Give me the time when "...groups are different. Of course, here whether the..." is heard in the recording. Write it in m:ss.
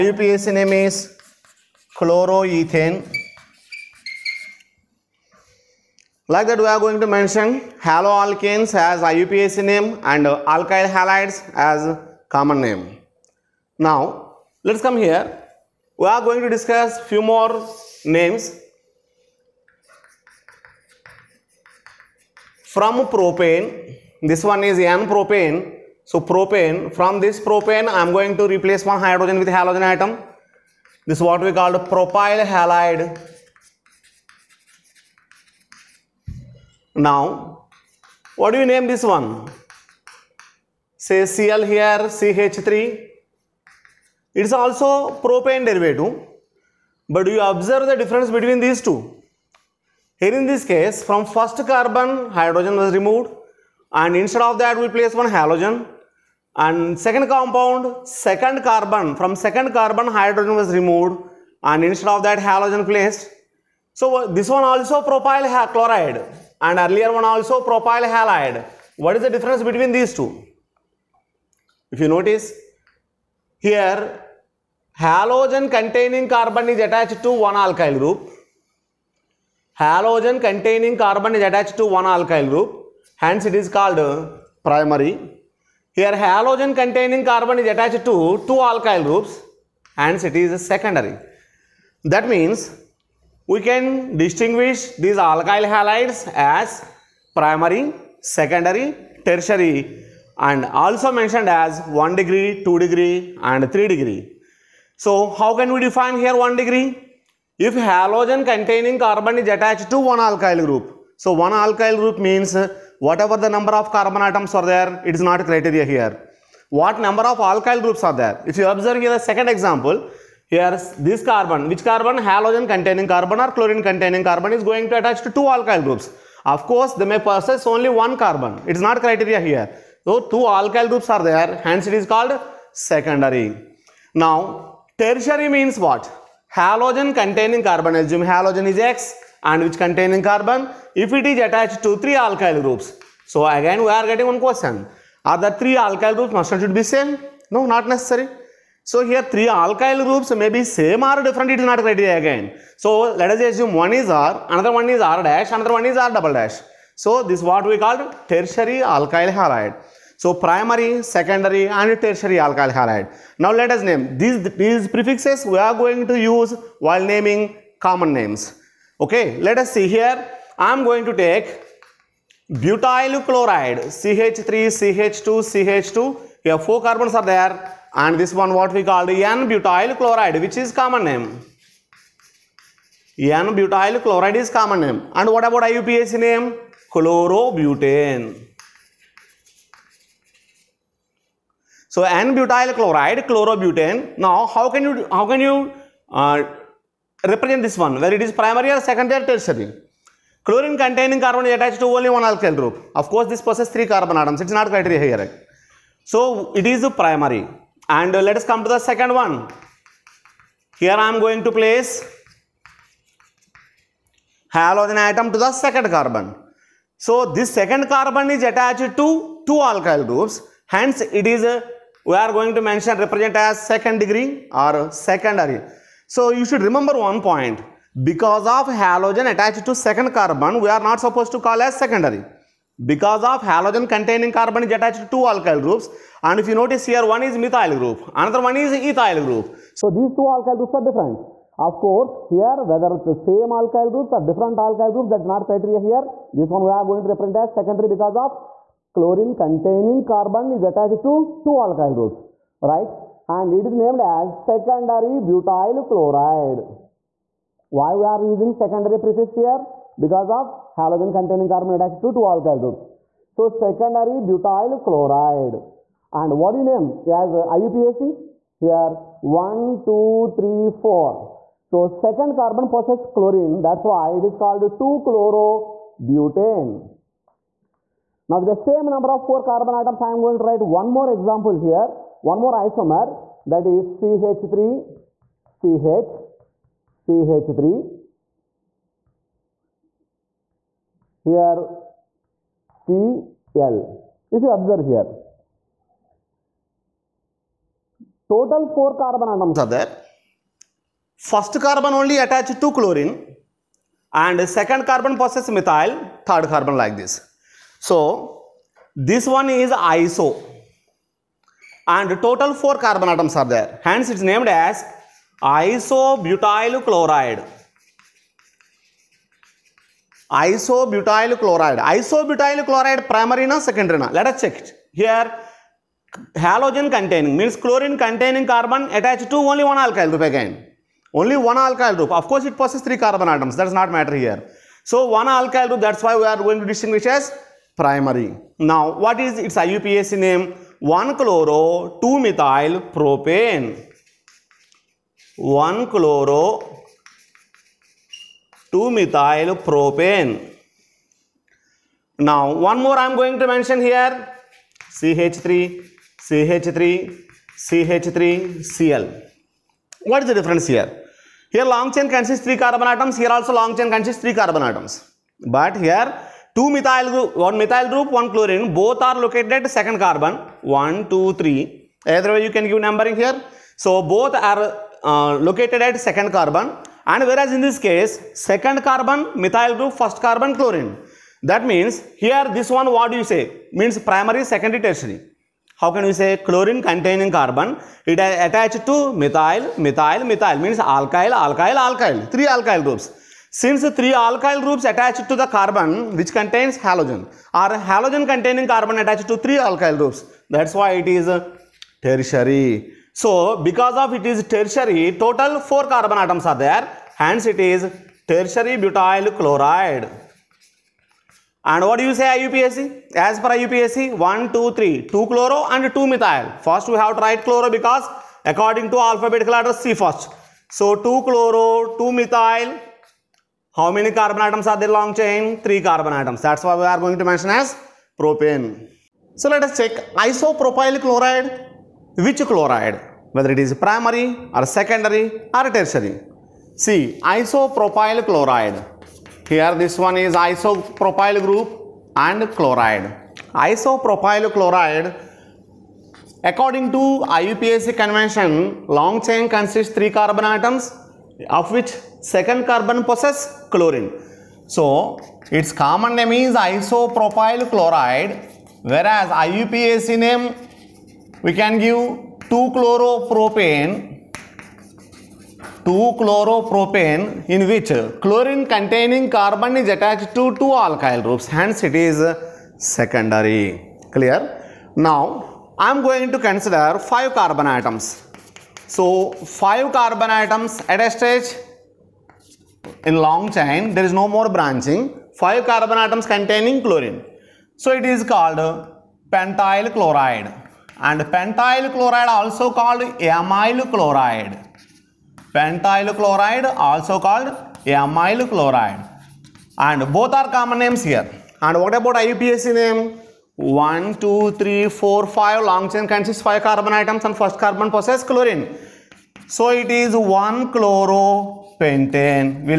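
4:00.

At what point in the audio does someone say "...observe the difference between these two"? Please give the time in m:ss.
0:47.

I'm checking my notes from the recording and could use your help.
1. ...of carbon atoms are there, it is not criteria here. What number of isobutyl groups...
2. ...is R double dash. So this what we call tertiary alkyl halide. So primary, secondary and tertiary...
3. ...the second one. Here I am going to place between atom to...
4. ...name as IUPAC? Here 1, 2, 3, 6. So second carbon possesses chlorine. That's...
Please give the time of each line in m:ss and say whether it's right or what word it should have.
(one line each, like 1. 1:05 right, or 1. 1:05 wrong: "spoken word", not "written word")
1. 1:53 wrong: "alkyl", not "isobutyl"
2. 2:35 right
3. 3:28 wrong: "halogen", not "between"
4. 4:26 wrong: "4", not "6".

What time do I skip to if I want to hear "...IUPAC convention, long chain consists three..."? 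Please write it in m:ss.
7:27.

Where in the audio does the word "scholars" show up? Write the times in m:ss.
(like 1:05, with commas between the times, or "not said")
not said.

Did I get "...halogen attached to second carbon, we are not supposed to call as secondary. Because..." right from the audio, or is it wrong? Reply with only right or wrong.
right.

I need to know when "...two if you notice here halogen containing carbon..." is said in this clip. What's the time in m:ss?
1:10.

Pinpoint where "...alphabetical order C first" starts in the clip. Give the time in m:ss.
6:58.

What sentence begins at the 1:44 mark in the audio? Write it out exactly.
So how can we define here 1 degree?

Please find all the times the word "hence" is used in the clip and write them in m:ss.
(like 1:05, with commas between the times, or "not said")
1:23, 2:11, 3:40, 5:13, 6:47, 7:51.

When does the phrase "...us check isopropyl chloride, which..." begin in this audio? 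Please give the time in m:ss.
7:09.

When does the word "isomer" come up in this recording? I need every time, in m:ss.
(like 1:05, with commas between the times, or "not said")
4:42.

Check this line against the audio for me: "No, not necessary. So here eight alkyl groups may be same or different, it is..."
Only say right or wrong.
wrong.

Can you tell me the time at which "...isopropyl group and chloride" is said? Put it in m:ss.
7:20.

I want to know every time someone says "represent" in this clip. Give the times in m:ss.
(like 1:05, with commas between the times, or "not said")
3:17, 3:42, 4:07.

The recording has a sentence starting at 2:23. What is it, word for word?
So again we are getting one question.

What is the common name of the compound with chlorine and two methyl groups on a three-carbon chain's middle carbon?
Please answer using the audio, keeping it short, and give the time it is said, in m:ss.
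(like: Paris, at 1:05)
tertiary butyl chloride, at 6:48.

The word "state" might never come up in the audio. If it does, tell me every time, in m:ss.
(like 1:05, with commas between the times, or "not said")
not said.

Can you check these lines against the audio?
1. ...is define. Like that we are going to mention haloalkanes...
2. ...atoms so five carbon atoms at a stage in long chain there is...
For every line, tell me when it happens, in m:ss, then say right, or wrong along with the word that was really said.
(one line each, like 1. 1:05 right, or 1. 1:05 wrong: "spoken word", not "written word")
1. 0:00 wrong: "chloroethane", not "define"
2. 7:57 right.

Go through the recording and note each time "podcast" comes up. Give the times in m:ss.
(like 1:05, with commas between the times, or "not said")
not said.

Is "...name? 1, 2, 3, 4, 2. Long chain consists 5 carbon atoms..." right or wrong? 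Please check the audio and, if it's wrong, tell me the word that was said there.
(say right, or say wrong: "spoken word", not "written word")
wrong: "5", not "2".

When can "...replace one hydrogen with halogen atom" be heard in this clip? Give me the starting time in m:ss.
0:28.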